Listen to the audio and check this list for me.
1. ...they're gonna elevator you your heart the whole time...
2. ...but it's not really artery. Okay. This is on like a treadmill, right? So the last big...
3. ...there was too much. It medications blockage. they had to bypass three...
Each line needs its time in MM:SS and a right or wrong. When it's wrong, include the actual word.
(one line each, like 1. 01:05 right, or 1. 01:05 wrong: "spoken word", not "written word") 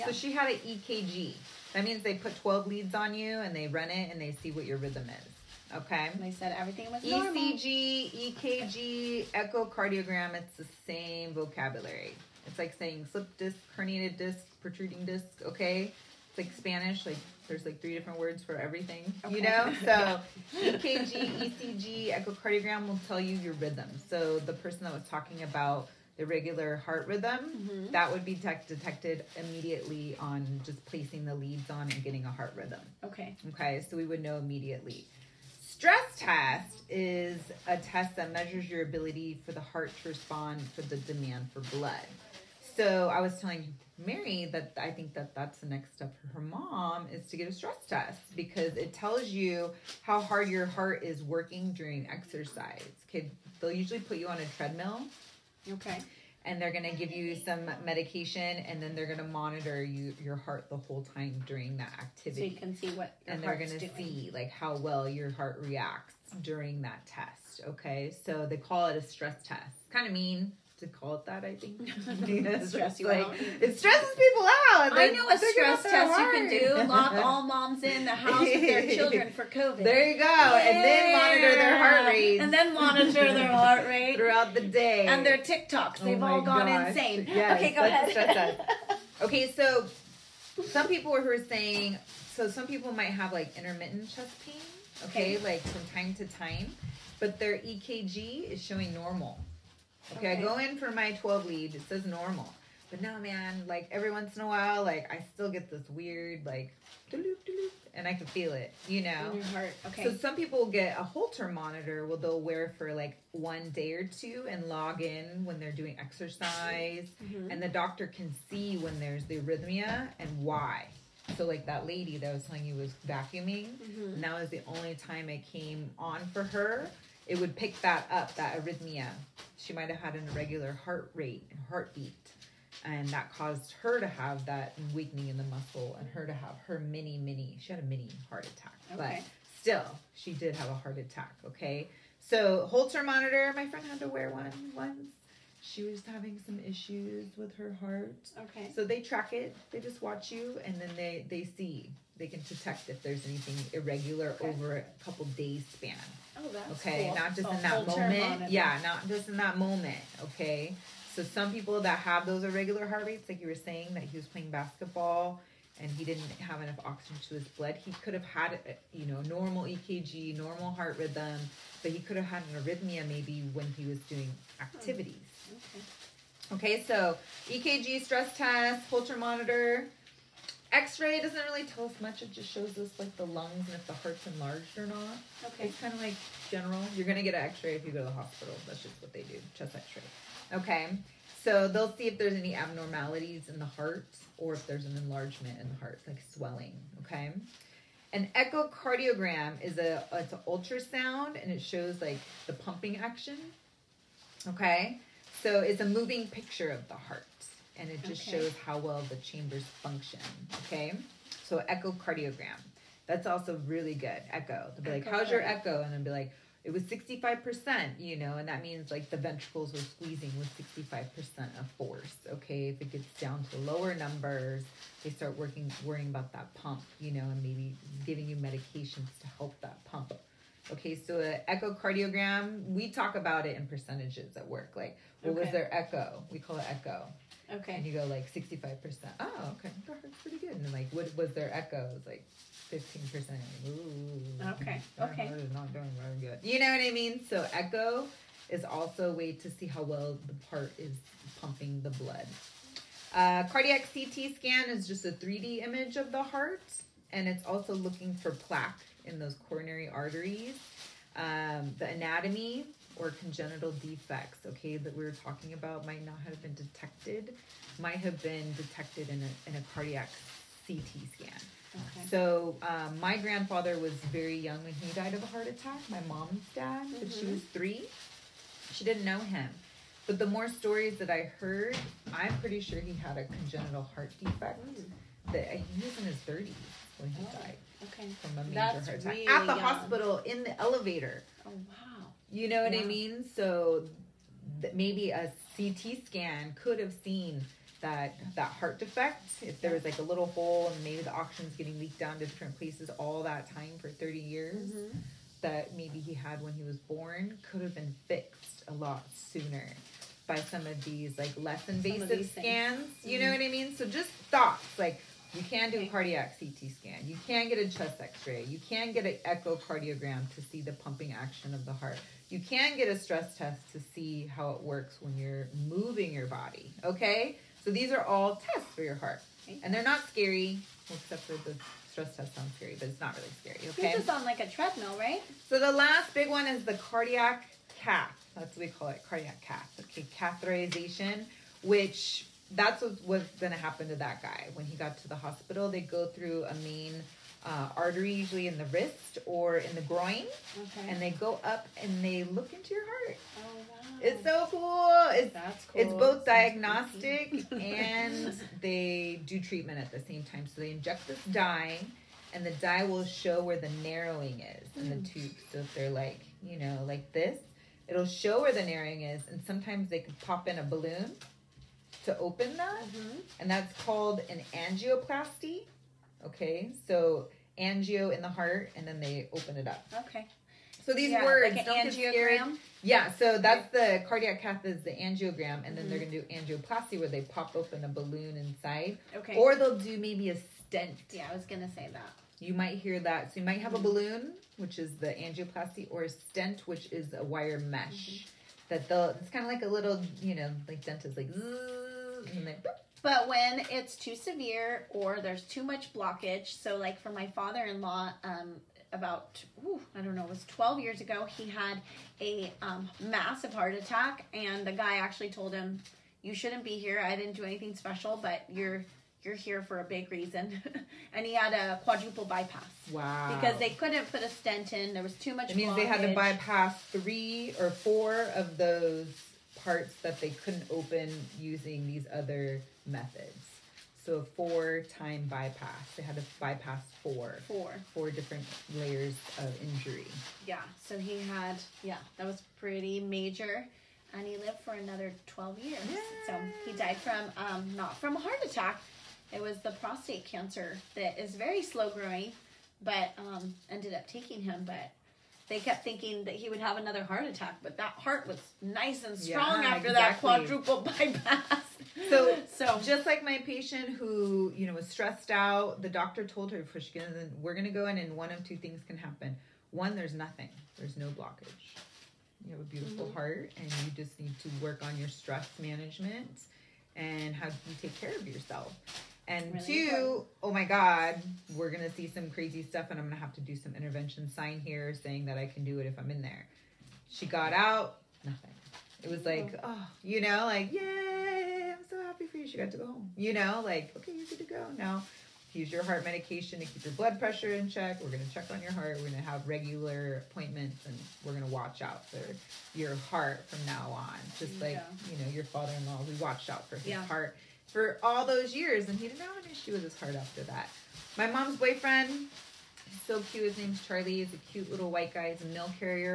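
1. 00:58 wrong: "monitor", not "elevator"
2. 05:32 wrong: "scary", not "artery"
3. 07:04 wrong: "means", not "medications".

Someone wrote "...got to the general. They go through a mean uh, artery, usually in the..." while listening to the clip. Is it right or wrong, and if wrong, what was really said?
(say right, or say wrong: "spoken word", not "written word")
wrong: "hospital", not "general".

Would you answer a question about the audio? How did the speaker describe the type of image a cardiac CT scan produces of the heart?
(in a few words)
3D image.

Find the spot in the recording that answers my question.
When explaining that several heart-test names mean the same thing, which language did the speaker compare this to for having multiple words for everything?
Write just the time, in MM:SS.
00:16.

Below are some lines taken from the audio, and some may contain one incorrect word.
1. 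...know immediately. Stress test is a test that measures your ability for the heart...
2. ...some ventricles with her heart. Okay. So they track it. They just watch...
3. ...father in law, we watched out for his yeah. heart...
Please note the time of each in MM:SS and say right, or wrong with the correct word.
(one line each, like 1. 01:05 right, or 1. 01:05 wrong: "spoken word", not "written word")
1. 00:34 right
2. 02:26 wrong: "issues", not "ventricles"
3. 08:25 right.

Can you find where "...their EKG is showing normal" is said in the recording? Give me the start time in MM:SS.
01:37.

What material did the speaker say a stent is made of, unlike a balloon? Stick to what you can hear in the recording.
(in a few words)
wire mesh.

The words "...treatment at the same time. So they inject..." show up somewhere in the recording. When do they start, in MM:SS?
05:59.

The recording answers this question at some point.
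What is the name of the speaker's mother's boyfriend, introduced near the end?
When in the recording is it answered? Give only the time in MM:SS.
08:33.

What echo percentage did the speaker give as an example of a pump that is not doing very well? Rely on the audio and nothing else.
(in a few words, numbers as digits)
15%.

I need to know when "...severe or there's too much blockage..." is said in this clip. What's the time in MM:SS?
06:44.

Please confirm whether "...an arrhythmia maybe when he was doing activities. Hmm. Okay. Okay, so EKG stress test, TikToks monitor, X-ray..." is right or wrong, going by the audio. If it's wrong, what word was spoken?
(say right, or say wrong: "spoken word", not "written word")
wrong: "Holter", not "TikToks".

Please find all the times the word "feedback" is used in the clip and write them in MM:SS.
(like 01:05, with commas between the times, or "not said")
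not said.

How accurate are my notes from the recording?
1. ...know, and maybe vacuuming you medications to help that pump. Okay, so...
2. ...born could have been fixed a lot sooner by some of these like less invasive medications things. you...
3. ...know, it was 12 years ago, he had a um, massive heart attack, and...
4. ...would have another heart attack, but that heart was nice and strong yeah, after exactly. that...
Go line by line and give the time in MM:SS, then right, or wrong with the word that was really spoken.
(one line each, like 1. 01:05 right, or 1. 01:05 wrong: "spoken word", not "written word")
1. 03:47 wrong: "giving", not "vacuuming"
2. 05:06 wrong: "scans", not "medications"
3. 06:50 right
4. 07:36 right.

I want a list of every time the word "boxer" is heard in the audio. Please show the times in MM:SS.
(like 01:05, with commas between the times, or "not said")
not said.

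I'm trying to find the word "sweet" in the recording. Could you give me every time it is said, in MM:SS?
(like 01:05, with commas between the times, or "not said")
not said.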